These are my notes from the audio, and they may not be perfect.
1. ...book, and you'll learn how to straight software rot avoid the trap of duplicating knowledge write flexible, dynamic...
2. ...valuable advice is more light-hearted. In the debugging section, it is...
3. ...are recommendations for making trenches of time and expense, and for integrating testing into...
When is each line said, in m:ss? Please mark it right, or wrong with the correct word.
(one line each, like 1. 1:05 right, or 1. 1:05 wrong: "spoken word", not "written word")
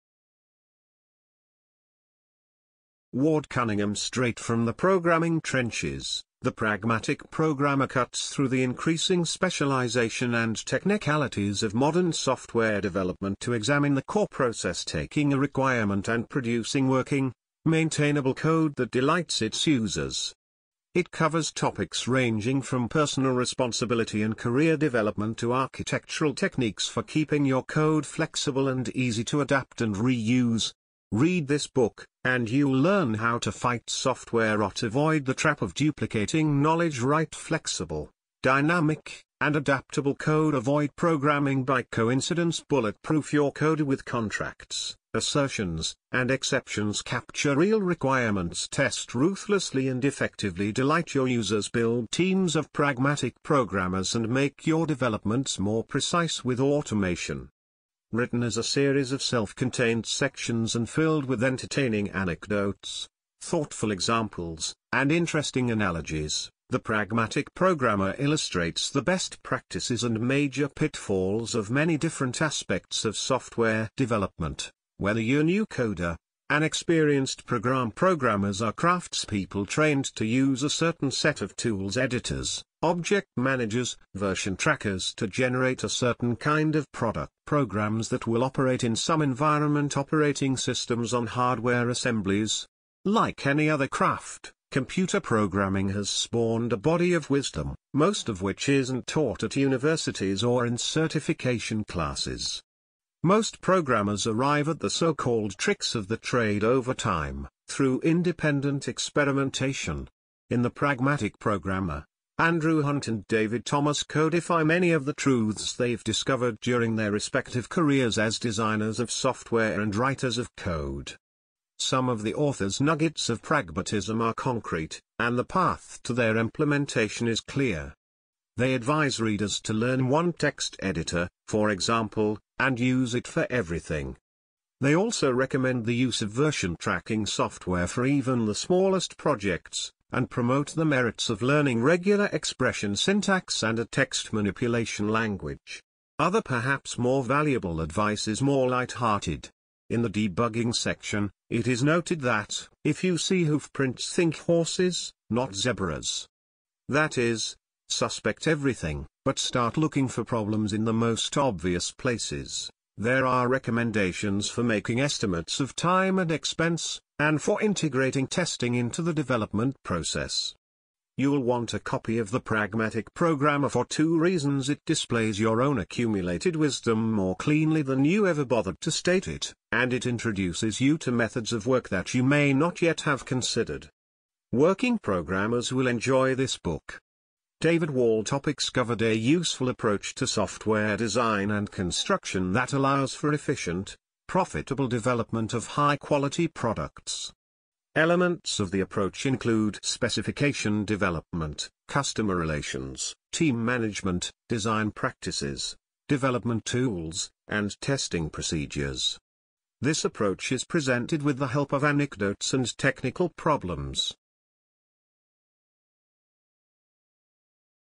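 1. 0:31 wrong: "fight", not "straight"
2. 2:27 right
3. 2:43 wrong: "estimates", not "trenches".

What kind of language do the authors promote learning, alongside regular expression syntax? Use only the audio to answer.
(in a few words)
A text manipulation language.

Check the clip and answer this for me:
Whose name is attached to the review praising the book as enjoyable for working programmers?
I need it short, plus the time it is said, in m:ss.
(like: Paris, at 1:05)
David Wall, at 3:07.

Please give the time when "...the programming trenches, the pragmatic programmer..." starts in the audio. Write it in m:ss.
0:04.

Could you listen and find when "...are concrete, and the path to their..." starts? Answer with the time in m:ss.
2:04.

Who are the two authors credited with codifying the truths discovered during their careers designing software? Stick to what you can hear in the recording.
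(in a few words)
Andrew Hunt and David Thomas.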